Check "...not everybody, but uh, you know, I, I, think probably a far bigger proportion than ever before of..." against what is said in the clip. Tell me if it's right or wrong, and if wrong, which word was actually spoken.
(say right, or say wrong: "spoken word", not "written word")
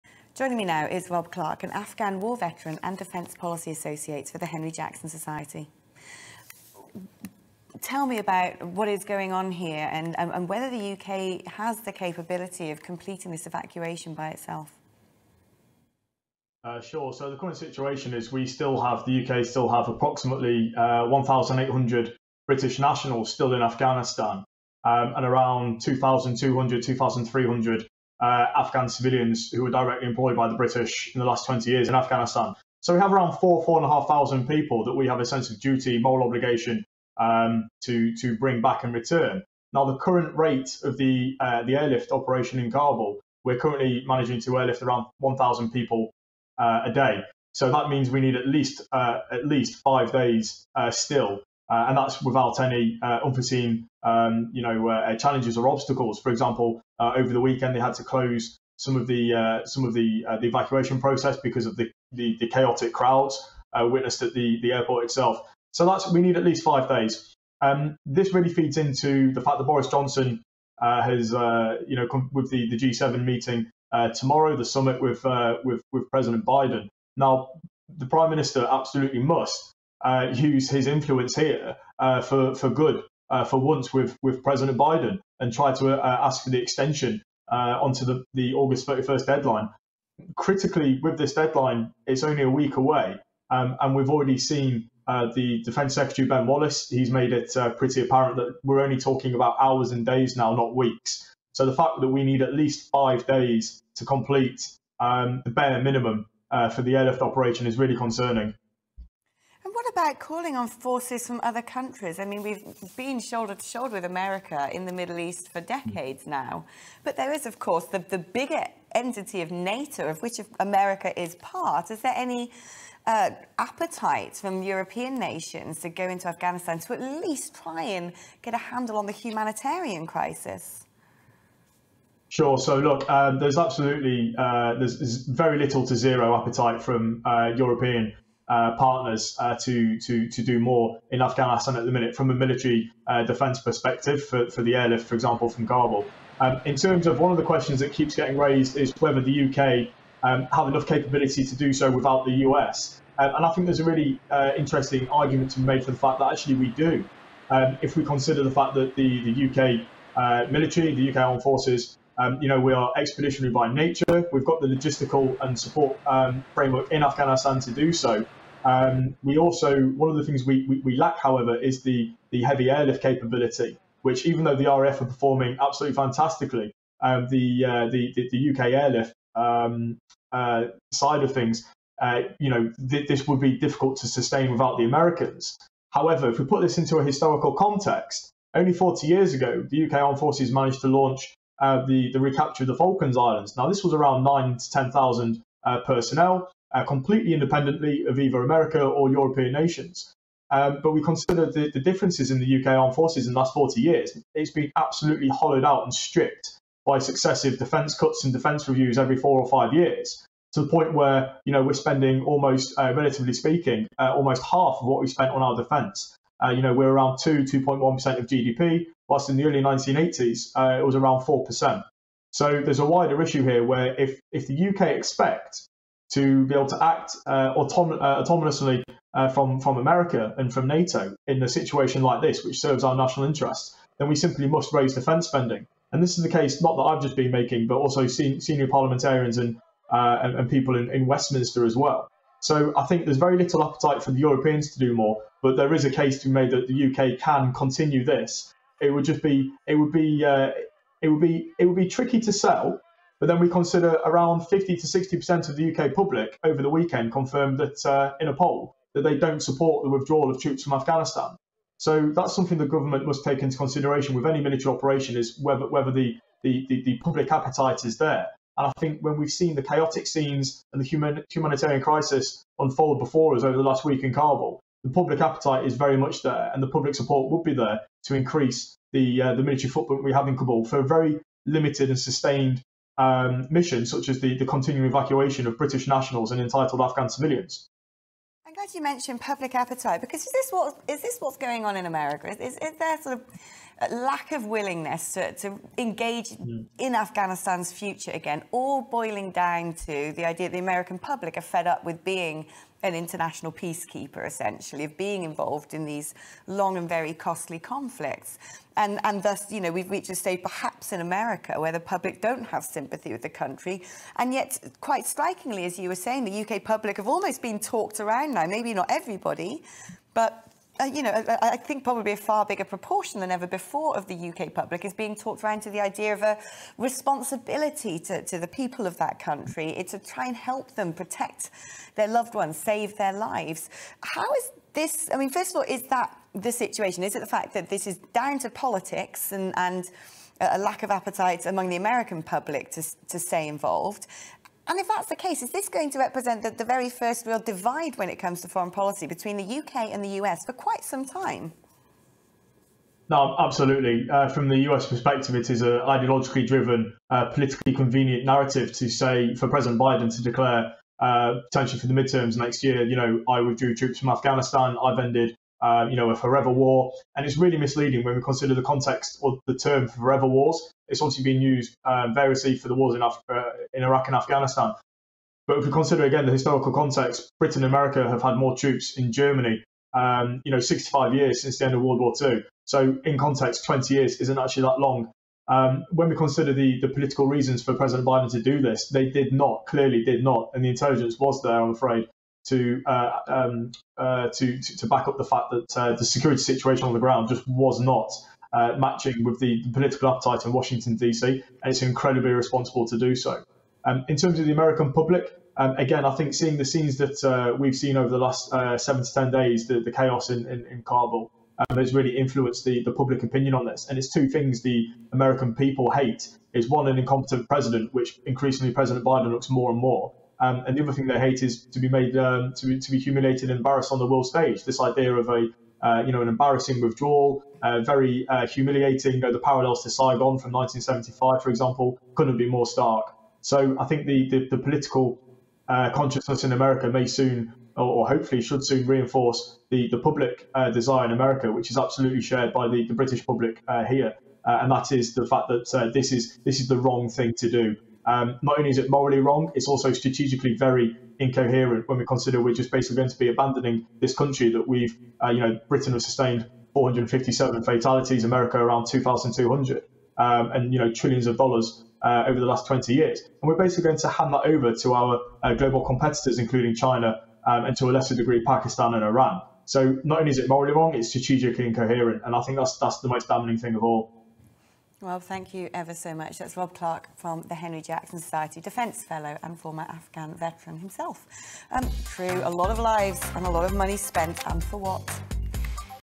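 right.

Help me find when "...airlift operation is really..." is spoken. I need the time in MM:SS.
01:46.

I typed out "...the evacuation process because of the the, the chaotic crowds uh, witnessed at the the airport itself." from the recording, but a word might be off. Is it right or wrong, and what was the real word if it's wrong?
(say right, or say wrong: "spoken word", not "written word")
right.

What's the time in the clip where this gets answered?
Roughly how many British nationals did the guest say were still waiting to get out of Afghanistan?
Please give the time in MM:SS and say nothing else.
00:21.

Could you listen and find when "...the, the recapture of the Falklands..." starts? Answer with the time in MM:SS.
03:11.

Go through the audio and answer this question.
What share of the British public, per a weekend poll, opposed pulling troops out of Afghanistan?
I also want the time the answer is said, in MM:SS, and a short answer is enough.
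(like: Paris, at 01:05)
50 to 60%, at 04:14.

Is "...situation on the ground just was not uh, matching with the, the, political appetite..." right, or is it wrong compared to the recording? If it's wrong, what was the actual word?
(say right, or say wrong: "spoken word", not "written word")
right.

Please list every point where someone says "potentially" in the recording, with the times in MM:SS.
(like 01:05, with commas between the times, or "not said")
06:01.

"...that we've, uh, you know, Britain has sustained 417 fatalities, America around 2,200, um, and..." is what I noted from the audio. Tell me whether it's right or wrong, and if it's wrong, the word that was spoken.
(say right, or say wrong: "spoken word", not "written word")
wrong: "457", not "417".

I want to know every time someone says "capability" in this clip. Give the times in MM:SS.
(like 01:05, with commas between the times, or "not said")
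00:11, 02:30, 02:53.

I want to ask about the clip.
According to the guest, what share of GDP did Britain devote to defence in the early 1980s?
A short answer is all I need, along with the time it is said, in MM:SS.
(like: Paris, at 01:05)
4 percent, at 03:41.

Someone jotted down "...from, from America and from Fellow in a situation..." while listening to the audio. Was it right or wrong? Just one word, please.
wrong.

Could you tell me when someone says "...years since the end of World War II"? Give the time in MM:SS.
06:21.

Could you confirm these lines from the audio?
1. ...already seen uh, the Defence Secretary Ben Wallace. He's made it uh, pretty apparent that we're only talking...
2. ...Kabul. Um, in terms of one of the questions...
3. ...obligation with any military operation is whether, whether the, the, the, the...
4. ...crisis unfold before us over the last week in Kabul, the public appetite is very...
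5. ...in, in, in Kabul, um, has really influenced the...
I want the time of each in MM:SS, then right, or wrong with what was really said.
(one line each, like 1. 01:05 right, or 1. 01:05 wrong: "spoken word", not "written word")
1. 01:34 right
2. 02:25 right
3. 04:23 wrong: "consideration", not "obligation"
4. 04:31 right
5. 06:50 right.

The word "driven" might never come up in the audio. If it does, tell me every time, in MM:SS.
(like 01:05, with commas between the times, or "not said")
05:56.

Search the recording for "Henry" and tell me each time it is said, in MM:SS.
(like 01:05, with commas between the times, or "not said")
00:04, 07:57.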